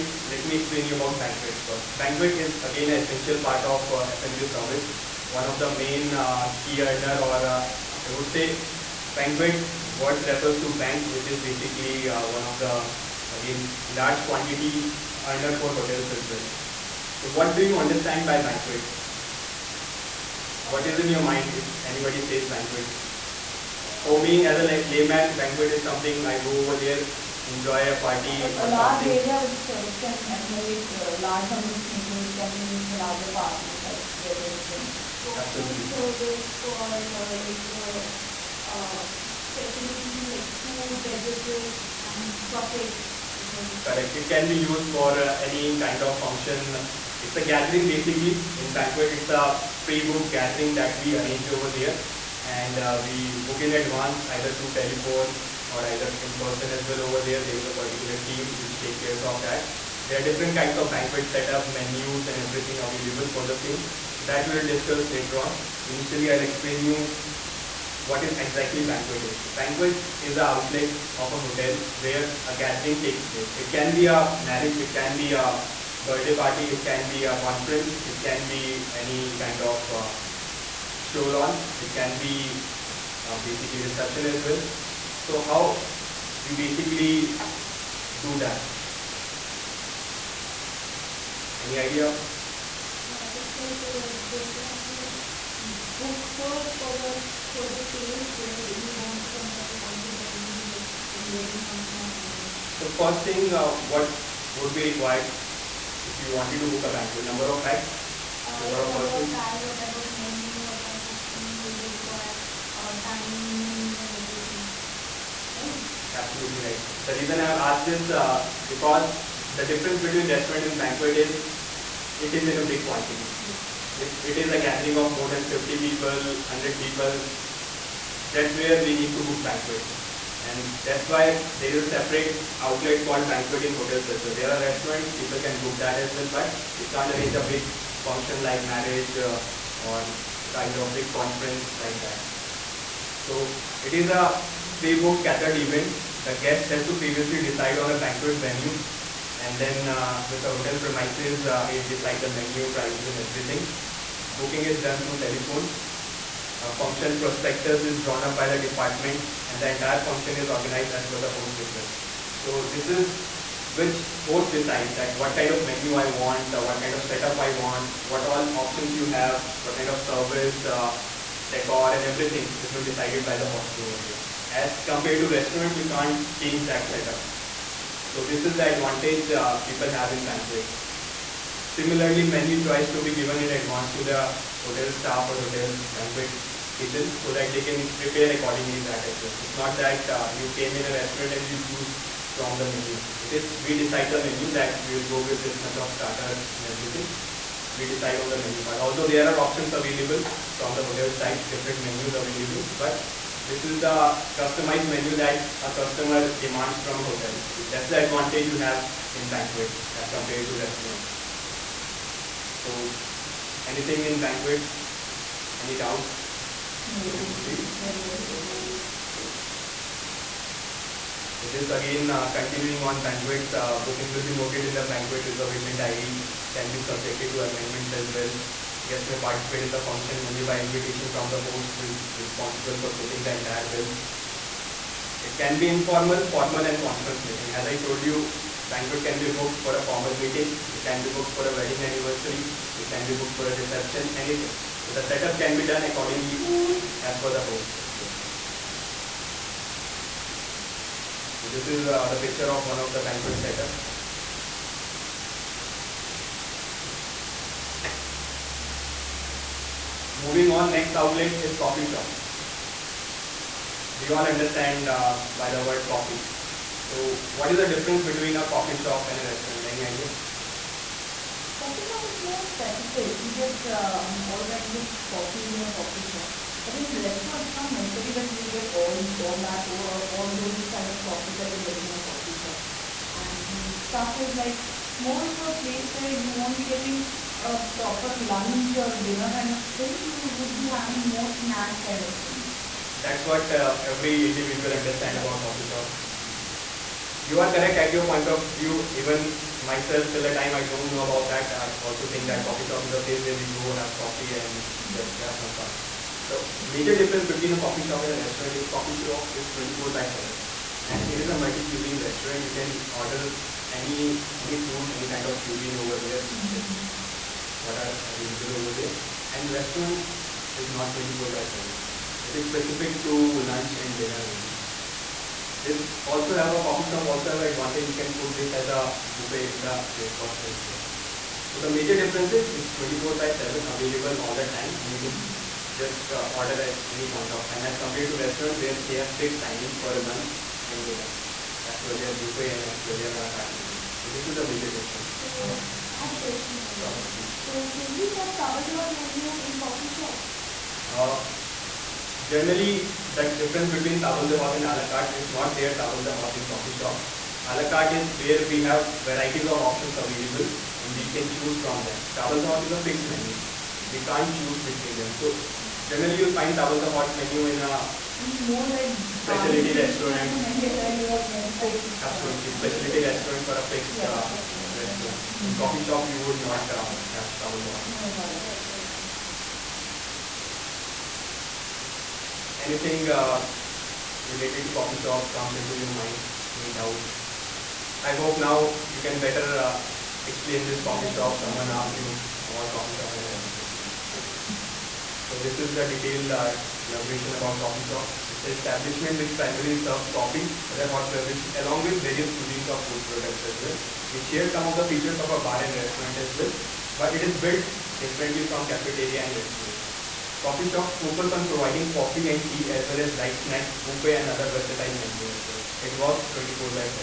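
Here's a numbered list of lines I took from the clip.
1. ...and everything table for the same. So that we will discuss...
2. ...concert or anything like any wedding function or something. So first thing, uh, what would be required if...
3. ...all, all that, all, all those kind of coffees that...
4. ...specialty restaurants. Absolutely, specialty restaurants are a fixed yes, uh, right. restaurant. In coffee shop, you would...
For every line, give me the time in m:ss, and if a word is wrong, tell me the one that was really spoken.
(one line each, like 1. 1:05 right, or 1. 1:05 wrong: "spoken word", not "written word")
1. 1:02 wrong: "available", not "table"
2. 1:39 right
3. 4:38 right
4. 6:09 right.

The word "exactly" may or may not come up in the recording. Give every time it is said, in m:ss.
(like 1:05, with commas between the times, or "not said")
1:08.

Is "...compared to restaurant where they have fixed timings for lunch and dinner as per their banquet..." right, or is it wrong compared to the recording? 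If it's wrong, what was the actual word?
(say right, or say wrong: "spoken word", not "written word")
wrong: "buffet", not "banquet".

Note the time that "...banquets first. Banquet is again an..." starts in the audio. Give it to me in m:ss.
0:01.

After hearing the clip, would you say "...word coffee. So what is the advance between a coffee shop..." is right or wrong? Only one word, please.
wrong.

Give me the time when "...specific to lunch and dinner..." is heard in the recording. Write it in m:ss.
5:22.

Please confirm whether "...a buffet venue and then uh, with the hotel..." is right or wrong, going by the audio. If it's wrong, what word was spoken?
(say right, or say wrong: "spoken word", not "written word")
wrong: "banquet", not "buffet".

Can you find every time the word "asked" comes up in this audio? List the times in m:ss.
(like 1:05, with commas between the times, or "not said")
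1:57, 6:31.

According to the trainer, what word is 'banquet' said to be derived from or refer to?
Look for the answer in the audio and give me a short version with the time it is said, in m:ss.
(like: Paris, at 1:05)
bank, at 0:10.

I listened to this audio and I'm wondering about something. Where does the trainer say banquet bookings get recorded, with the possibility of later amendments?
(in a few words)
banquet reservation diary.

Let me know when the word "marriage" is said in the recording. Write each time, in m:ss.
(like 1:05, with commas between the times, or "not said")
1:14, 2:18.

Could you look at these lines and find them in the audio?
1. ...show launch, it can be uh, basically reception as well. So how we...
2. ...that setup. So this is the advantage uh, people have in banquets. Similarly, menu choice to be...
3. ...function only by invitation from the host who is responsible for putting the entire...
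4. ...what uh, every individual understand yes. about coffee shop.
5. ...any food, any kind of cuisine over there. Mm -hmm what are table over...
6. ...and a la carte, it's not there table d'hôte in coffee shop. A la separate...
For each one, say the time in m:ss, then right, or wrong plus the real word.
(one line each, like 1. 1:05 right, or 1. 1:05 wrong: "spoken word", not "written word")
1. 1:21 right
2. 2:56 right
3. 3:49 right
4. 4:53 right
5. 5:14 wrong: "available", not "table"
6. 5:54 wrong: "carte", not "separate".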